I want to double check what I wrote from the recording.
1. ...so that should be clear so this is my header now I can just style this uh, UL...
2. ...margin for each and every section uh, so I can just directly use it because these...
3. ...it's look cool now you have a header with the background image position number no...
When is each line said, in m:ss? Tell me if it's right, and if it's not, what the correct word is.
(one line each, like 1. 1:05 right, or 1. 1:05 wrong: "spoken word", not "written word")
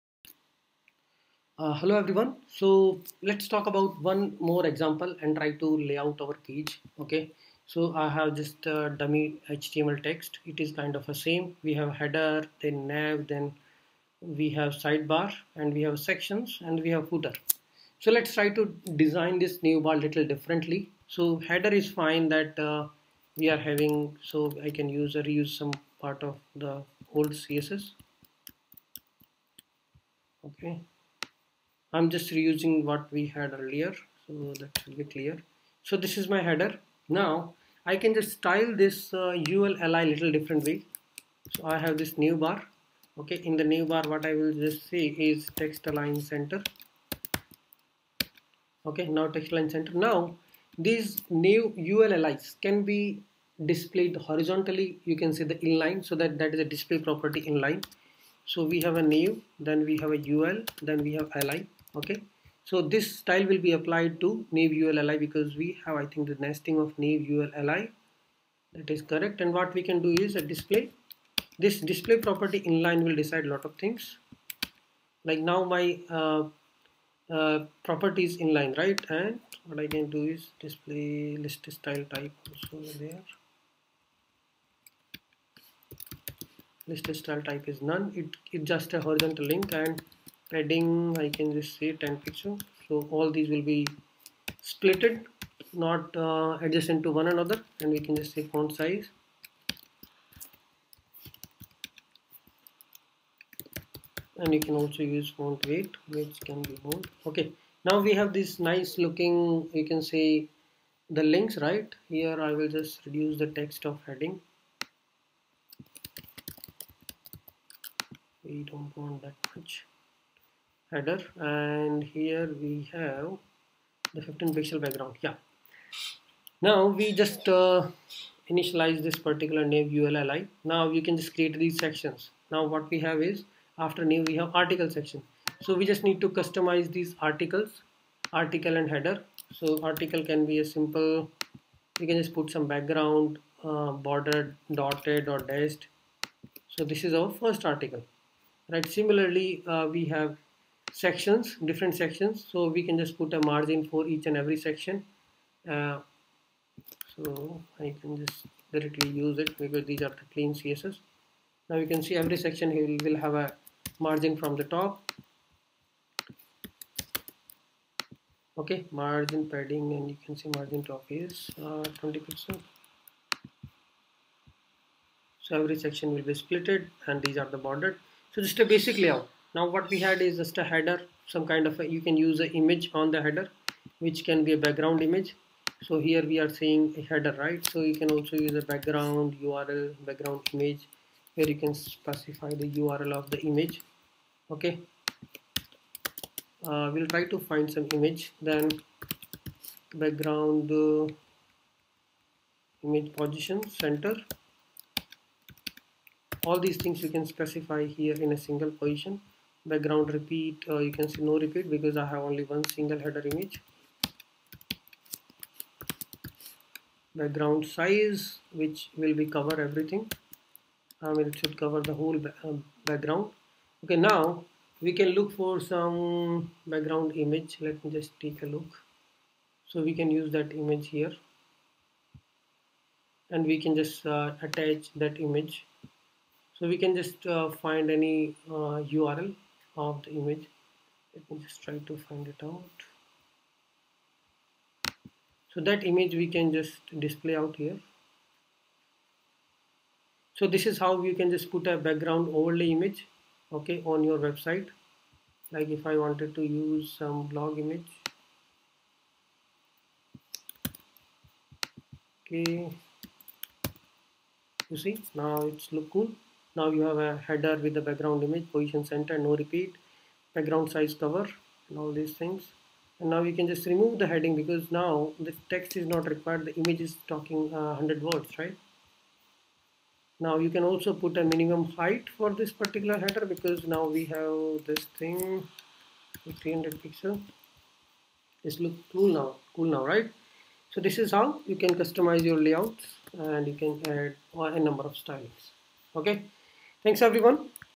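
1. 0:34 right
2. 2:33 right
3. 4:25 wrong: "center", not "number".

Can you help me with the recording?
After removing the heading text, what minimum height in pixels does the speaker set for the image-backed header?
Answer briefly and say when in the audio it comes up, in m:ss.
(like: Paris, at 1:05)
300 pixels, at 4:46.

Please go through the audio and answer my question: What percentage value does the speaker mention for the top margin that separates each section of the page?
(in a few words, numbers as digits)
20 percent.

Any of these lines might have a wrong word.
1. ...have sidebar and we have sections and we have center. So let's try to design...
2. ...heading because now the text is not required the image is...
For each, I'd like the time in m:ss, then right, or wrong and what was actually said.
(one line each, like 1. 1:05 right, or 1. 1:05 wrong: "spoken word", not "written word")
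1. 0:14 wrong: "footer", not "center"
2. 4:34 right.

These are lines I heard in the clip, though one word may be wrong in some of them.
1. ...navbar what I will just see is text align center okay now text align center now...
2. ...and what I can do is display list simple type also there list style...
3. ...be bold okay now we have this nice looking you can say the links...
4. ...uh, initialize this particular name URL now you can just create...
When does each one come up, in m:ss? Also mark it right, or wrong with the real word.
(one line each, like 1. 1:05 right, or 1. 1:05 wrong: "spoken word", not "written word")
1. 0:43 right
2. 1:19 wrong: "style", not "simple"
3. 1:46 right
4. 2:07 wrong: "ULLI", not "URL".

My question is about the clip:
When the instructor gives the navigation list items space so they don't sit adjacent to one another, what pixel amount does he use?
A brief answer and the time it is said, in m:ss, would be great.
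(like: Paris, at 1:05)
10 pixels, at 1:31.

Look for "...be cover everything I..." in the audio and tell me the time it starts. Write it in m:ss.
3:39.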